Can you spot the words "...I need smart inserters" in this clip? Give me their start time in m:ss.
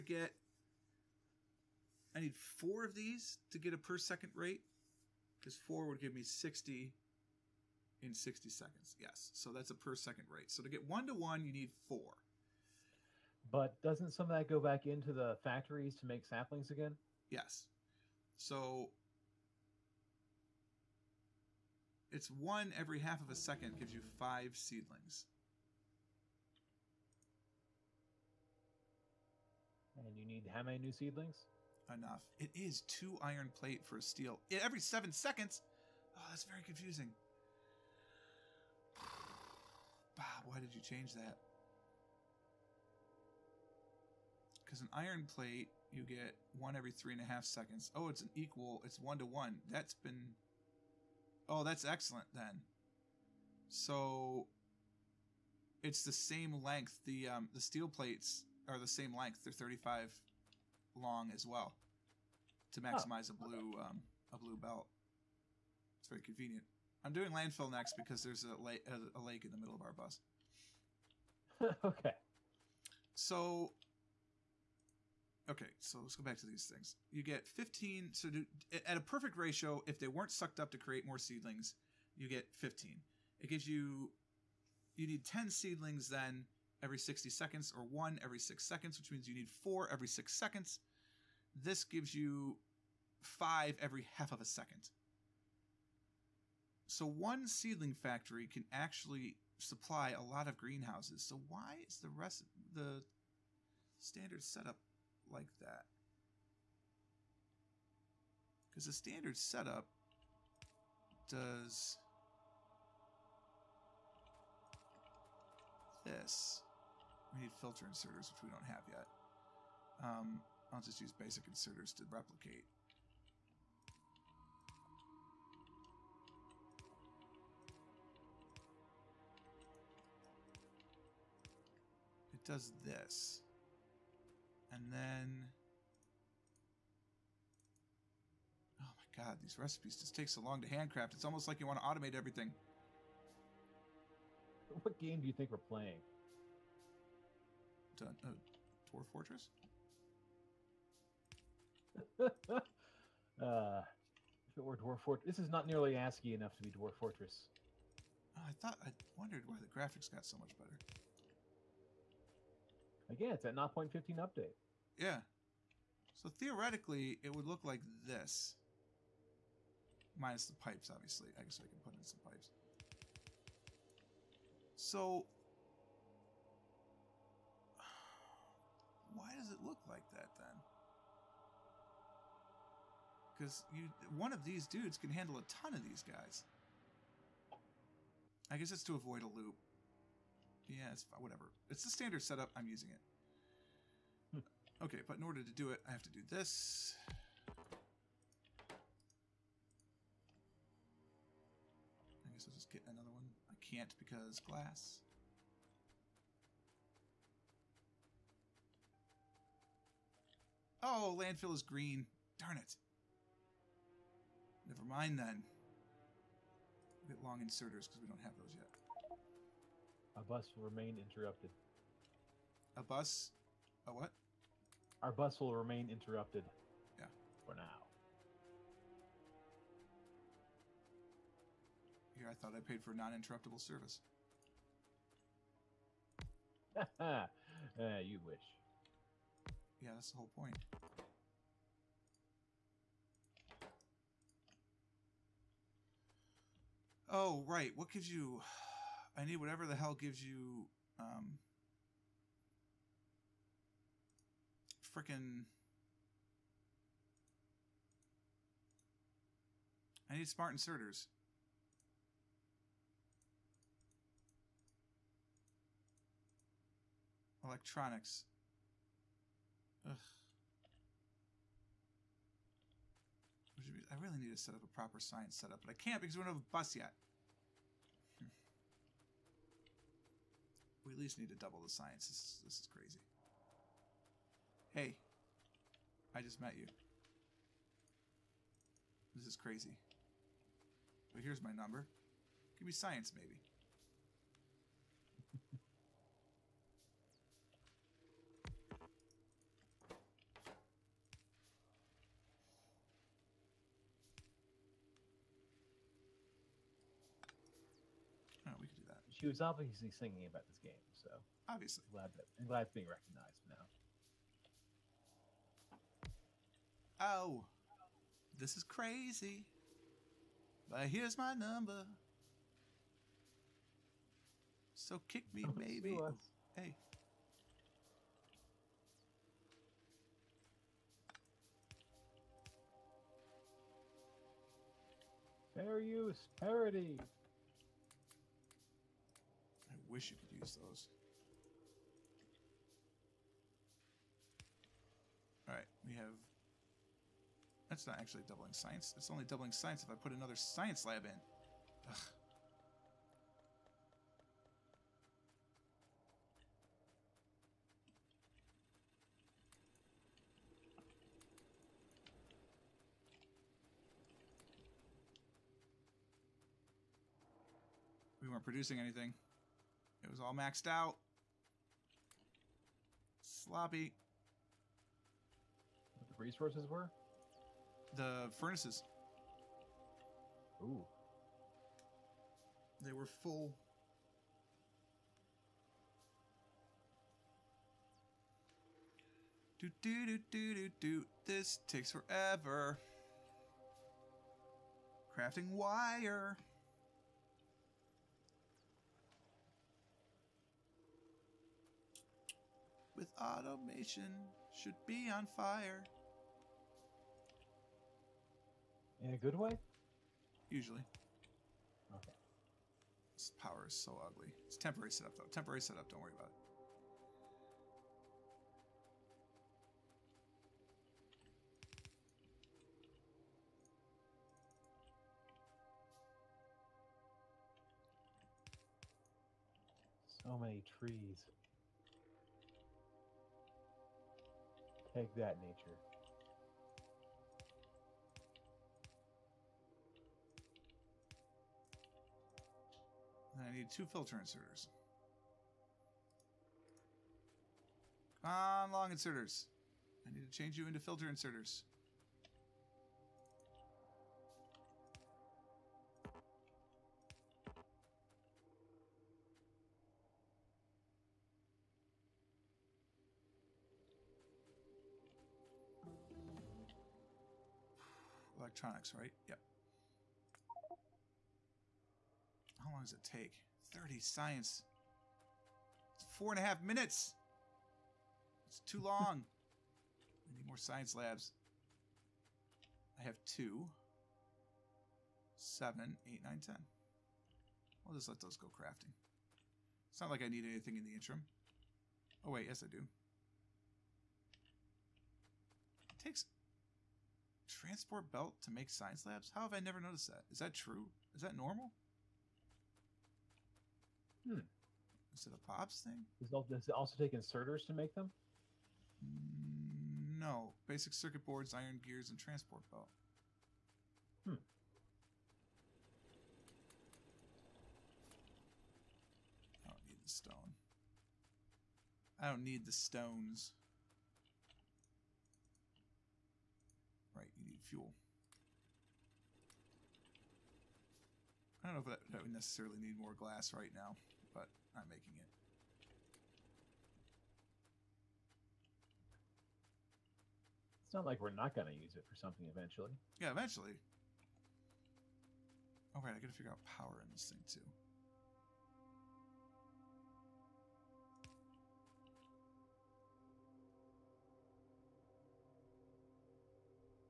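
4:20.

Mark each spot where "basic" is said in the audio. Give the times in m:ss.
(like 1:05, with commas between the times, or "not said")
2:01, 8:30.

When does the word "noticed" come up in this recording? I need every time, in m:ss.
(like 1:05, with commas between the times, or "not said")
8:19.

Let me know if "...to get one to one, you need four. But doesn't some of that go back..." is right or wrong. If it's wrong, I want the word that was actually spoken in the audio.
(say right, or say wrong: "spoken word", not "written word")
right.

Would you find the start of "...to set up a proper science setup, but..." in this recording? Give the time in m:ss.
4:34.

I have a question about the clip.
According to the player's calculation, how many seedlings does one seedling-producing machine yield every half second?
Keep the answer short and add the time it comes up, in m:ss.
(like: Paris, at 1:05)
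5, at 0:24.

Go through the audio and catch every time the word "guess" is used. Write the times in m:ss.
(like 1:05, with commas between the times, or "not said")
2:51, 3:08, 3:22.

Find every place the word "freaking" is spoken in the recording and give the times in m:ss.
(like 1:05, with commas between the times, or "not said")
4:14.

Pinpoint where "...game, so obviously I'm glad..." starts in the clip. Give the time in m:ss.
5:10.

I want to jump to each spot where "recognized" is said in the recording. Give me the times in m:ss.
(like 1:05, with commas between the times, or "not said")
5:12.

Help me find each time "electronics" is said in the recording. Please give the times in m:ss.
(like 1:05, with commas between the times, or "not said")
4:27, 7:48.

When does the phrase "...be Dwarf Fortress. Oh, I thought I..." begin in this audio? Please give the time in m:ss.
2:36.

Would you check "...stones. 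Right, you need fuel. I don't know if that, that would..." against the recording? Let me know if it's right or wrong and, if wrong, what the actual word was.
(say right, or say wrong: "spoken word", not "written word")
right.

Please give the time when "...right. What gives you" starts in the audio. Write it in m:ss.
4:07.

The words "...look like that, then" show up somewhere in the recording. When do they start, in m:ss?
2:59.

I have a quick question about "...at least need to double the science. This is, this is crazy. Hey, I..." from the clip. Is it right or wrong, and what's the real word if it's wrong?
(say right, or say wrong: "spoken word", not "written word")
right.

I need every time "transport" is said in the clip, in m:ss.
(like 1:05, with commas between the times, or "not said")
8:17, 8:32.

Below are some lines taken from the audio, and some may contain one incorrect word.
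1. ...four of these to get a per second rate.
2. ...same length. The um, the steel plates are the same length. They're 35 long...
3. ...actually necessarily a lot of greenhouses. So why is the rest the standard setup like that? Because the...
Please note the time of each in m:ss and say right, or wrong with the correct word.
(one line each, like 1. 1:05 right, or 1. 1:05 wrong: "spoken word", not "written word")
1. 0:02 right
2. 0:56 right
3. 1:38 wrong: "supply", not "necessarily".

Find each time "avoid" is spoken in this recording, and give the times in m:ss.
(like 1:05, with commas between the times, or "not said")
3:08.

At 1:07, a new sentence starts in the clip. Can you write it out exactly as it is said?
I'm doing landfill next because there's a, la- a lake in the middle of our bus.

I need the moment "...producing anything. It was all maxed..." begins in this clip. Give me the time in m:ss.
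6:08.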